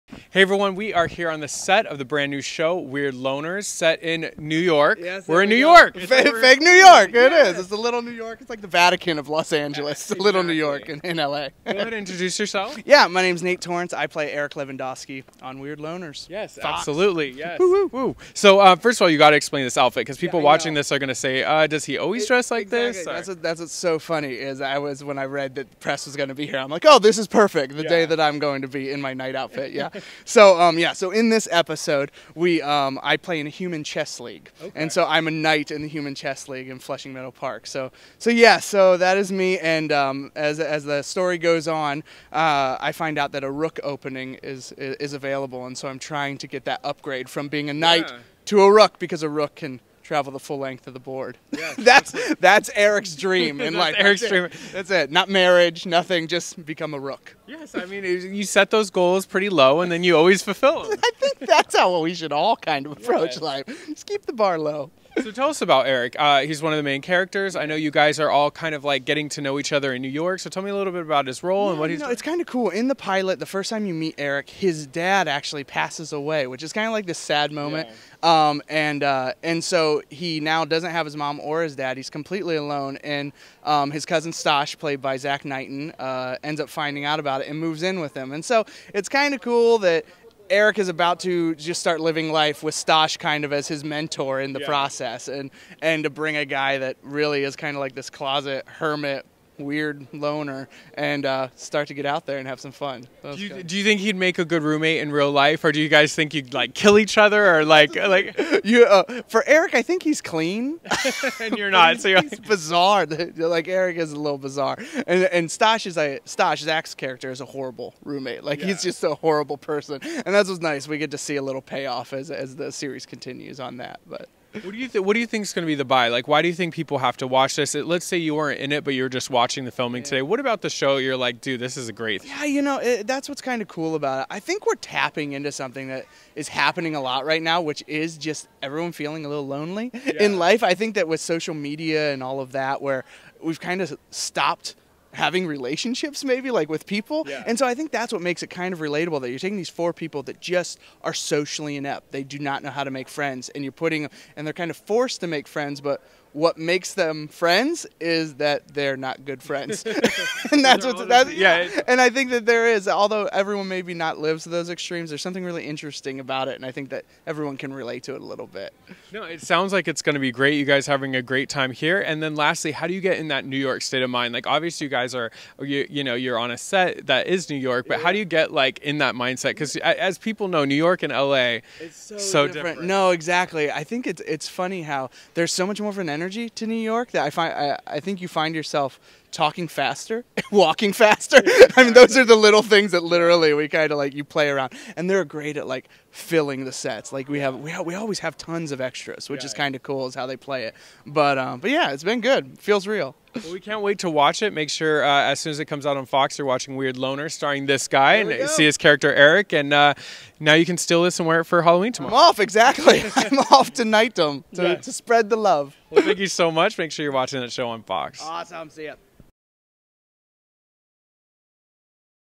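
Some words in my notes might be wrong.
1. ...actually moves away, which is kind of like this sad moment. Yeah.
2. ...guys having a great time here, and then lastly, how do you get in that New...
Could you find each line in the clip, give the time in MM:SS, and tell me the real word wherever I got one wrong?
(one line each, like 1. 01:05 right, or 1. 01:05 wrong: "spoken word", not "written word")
1. 01:15 wrong: "passes", not "moves"
2. 02:50 right.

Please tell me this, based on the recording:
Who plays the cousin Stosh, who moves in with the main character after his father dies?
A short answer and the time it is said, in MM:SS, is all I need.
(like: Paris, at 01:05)
Zach Knighton, at 01:25.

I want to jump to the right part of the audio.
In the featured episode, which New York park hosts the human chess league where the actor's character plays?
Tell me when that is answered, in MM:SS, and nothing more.
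00:36.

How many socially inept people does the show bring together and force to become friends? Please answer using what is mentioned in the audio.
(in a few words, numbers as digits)
4.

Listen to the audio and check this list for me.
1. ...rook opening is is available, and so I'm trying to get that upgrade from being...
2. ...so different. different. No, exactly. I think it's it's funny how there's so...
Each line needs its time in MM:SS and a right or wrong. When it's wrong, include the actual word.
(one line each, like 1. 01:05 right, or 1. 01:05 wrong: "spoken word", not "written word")
1. 00:43 right
2. 03:02 right.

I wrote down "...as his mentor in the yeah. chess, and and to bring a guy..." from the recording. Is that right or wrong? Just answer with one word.
wrong.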